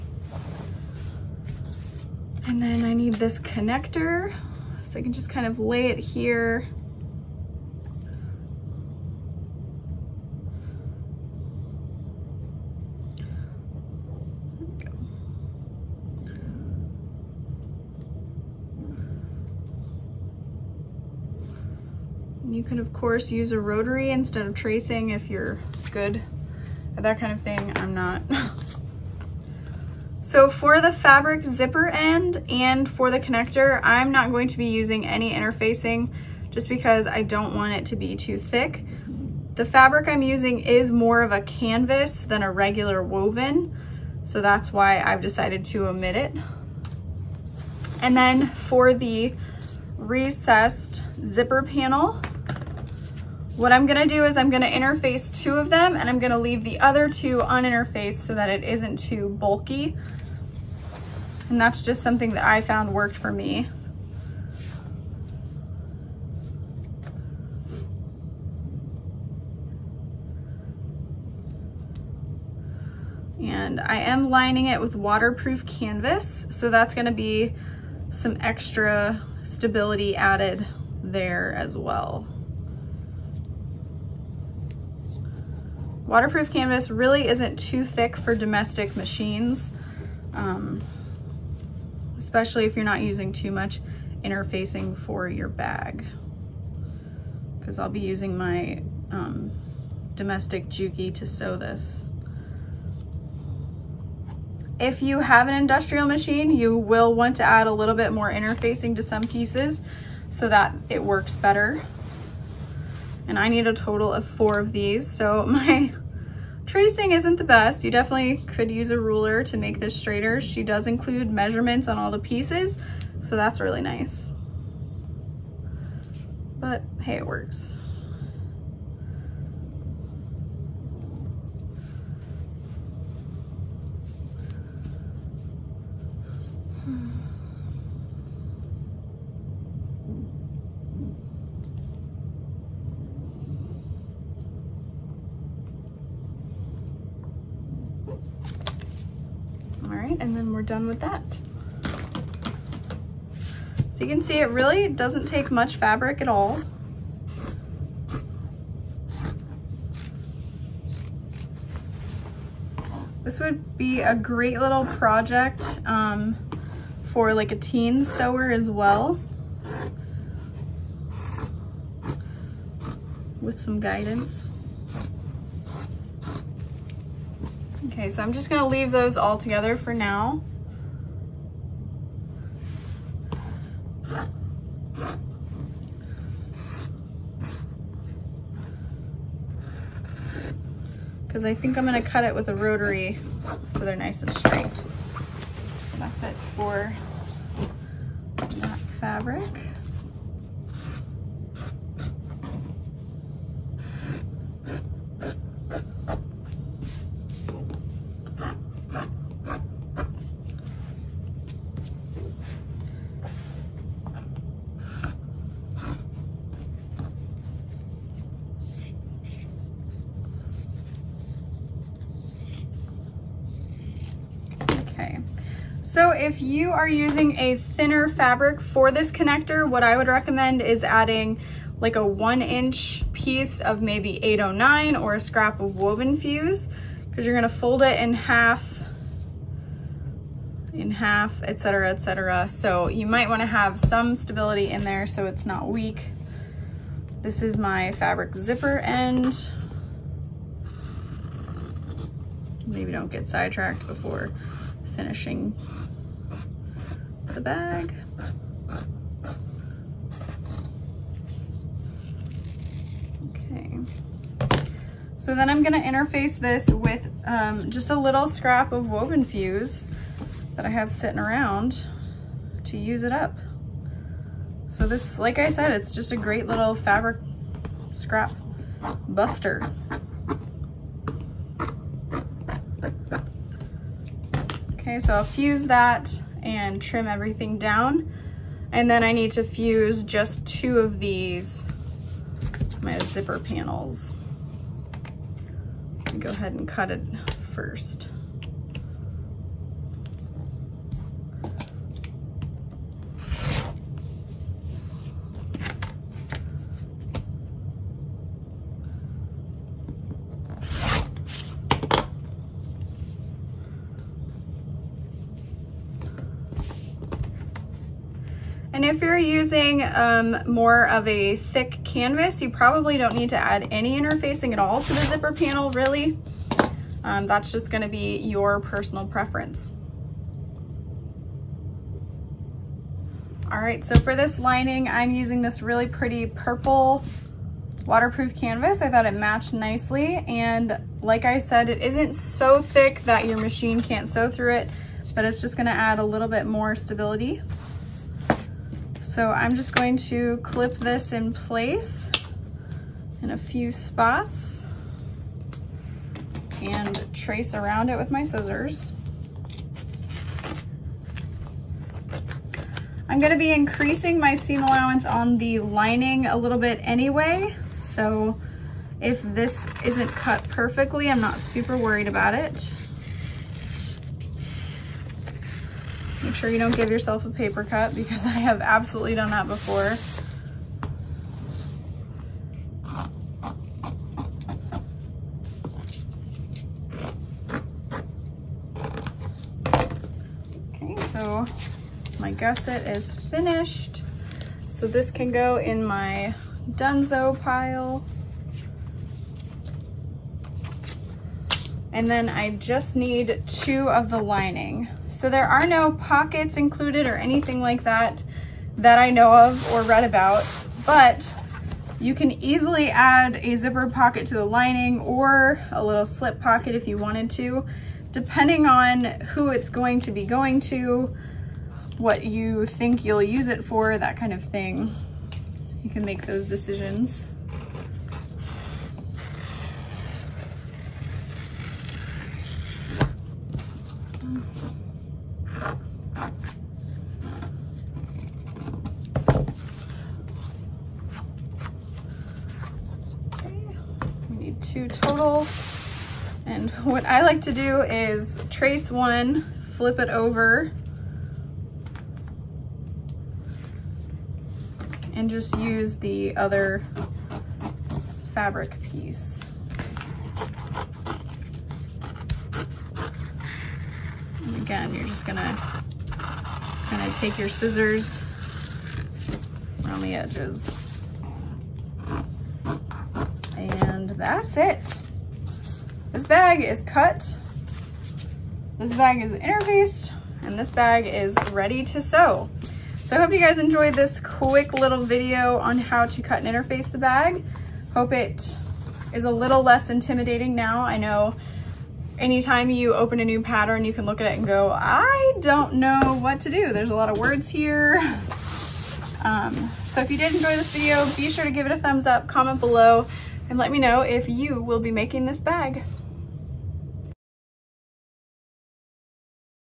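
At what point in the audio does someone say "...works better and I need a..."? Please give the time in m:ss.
1:51.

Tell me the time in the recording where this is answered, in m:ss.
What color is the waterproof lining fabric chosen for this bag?
5:36.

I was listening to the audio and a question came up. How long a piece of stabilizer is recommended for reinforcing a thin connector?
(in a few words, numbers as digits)
1 inch.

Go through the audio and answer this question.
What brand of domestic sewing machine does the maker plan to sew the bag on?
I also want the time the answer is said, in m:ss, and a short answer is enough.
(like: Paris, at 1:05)
Juki, at 1:40.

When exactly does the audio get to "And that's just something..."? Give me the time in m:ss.
1:01.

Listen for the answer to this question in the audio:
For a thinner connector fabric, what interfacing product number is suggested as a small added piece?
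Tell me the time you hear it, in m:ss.
3:54.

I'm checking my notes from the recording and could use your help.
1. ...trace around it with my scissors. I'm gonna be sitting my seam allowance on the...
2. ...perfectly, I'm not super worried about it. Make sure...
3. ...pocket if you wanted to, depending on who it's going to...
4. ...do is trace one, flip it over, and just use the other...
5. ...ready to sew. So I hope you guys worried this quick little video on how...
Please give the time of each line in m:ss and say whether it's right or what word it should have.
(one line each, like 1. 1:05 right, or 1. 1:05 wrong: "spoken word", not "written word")
1. 5:57 wrong: "increasing", not "sitting"
2. 6:10 right
3. 6:56 right
4. 7:27 right
5. 8:01 wrong: "enjoyed", not "worried".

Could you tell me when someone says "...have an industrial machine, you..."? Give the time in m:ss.
1:45.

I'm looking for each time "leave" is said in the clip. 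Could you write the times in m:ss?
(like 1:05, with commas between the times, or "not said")
0:56, 2:58.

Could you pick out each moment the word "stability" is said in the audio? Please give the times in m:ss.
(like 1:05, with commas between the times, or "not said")
1:19, 4:04, 5:46.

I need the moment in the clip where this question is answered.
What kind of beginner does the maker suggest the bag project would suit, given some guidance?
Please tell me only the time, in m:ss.
2:47.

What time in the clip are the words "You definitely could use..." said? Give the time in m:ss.
1:57.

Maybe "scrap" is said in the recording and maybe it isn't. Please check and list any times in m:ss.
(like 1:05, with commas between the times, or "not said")
3:55, 4:28, 4:37.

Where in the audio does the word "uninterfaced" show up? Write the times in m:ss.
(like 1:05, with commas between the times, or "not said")
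0:57.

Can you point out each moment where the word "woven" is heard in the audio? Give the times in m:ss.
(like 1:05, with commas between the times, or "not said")
0:43, 3:55, 4:28.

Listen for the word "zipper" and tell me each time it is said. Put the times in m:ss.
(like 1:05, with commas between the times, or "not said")
0:31, 0:51, 4:08, 4:52, 5:25, 6:53.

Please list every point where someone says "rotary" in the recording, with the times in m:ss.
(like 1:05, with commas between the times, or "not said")
0:23, 3:12.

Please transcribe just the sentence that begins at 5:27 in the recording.
Um, that's just gonna be your personal preference.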